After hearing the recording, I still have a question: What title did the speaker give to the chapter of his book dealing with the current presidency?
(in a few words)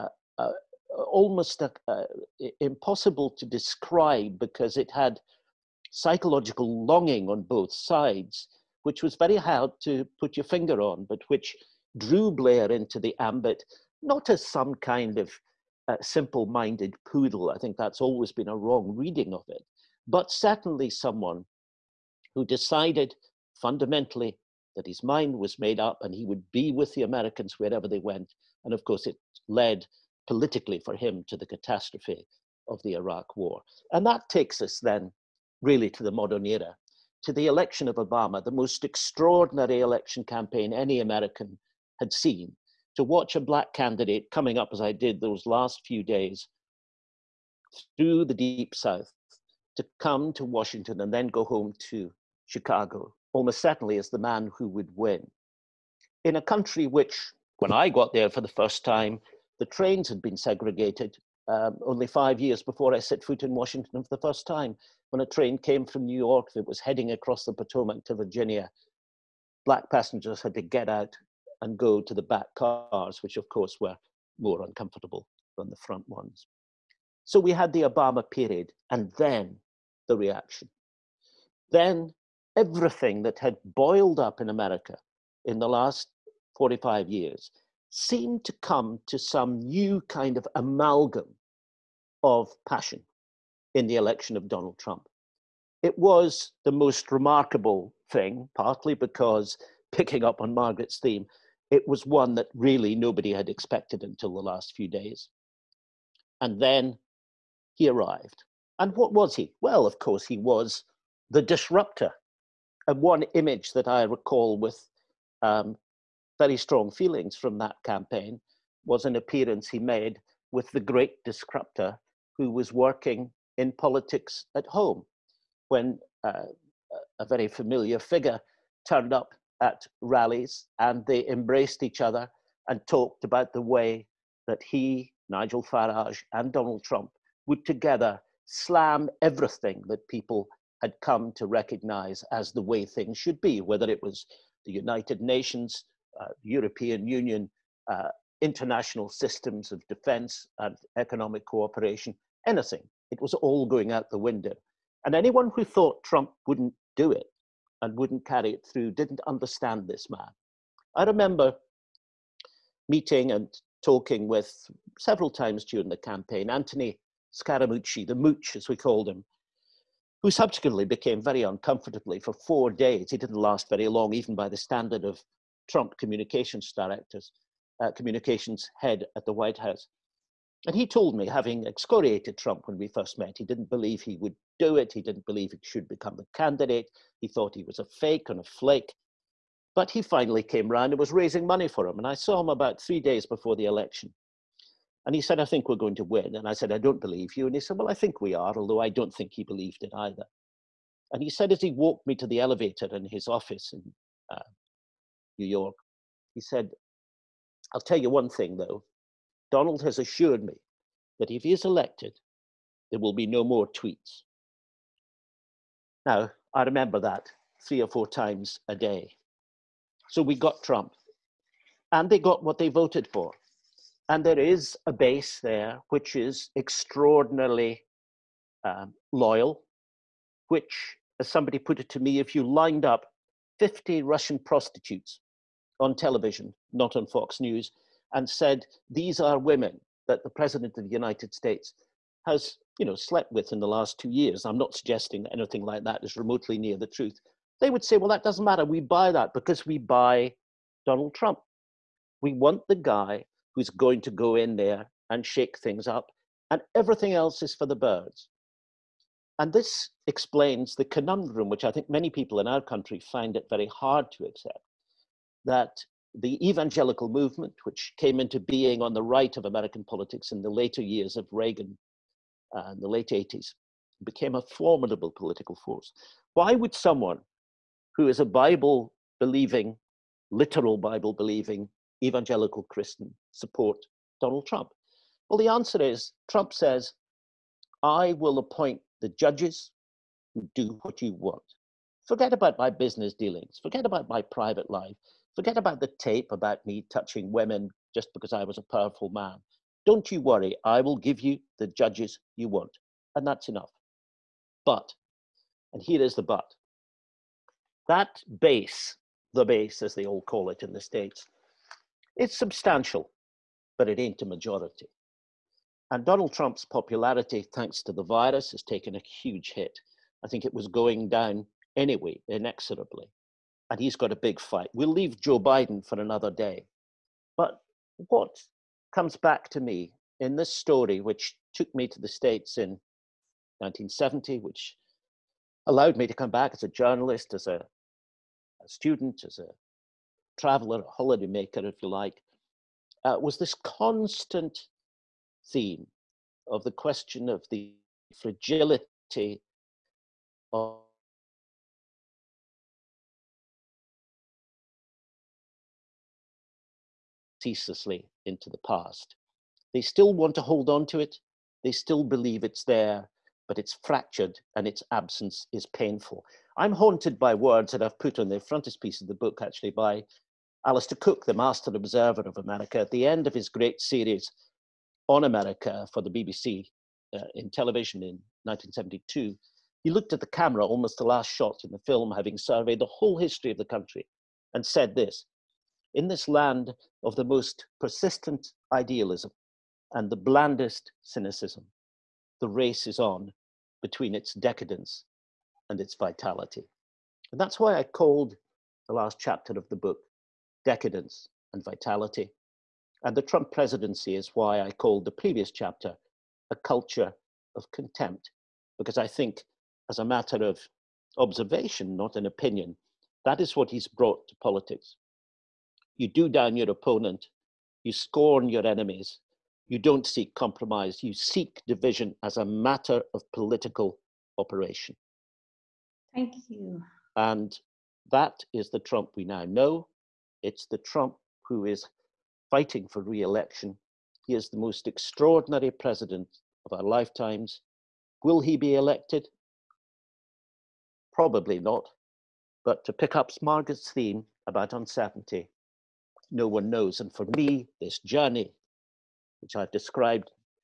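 A Culture of Contempt.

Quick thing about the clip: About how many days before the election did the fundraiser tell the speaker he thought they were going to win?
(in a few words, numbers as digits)
3.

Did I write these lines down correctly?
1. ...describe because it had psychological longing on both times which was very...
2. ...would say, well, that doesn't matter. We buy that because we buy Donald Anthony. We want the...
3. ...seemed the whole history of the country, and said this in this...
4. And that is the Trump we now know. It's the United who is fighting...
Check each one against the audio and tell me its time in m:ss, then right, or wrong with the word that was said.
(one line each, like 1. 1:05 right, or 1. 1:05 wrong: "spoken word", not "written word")
1. 0:03 wrong: "sides", not "times"
2. 4:07 wrong: "Trump", not "Anthony"
3. 6:22 wrong: "surveyed", not "seemed"
4. 7:07 wrong: "Trump", not "United".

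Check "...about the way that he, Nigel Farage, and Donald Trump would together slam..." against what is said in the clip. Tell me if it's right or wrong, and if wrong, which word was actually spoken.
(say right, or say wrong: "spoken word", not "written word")
right.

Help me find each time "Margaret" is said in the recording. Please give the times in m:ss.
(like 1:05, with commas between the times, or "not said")
1:40, 7:23.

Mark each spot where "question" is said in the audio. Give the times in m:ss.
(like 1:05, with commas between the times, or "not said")
5:46.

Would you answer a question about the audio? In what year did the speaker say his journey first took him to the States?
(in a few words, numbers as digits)
1970.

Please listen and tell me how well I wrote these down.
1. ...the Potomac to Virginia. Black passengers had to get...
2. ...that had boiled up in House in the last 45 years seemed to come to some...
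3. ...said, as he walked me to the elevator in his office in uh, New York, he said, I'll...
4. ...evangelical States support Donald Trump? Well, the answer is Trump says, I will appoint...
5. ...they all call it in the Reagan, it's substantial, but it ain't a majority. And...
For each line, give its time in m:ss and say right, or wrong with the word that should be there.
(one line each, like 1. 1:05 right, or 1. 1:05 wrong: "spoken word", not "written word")
1. 1:07 right
2. 1:23 wrong: "America", not "House"
3. 3:21 right
4. 4:42 wrong: "Christian", not "States"
5. 5:09 wrong: "States", not "Reagan".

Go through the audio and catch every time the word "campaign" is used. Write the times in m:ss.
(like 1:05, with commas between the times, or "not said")
0:40, 1:57, 2:45.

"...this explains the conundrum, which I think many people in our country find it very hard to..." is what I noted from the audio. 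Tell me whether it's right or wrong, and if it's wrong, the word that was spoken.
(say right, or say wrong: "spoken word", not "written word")
right.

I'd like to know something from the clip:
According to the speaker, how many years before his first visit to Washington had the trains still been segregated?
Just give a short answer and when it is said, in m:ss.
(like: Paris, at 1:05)
5, at 1:02.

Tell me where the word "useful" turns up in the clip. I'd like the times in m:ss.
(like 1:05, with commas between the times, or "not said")
not said.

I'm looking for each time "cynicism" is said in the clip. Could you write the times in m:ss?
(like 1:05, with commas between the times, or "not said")
6:31.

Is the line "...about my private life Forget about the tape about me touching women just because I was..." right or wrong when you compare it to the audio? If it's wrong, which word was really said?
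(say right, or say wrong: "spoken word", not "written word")
right.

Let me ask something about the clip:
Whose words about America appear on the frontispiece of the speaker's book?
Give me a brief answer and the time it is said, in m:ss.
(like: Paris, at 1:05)
Alistair Cooke, at 6:10.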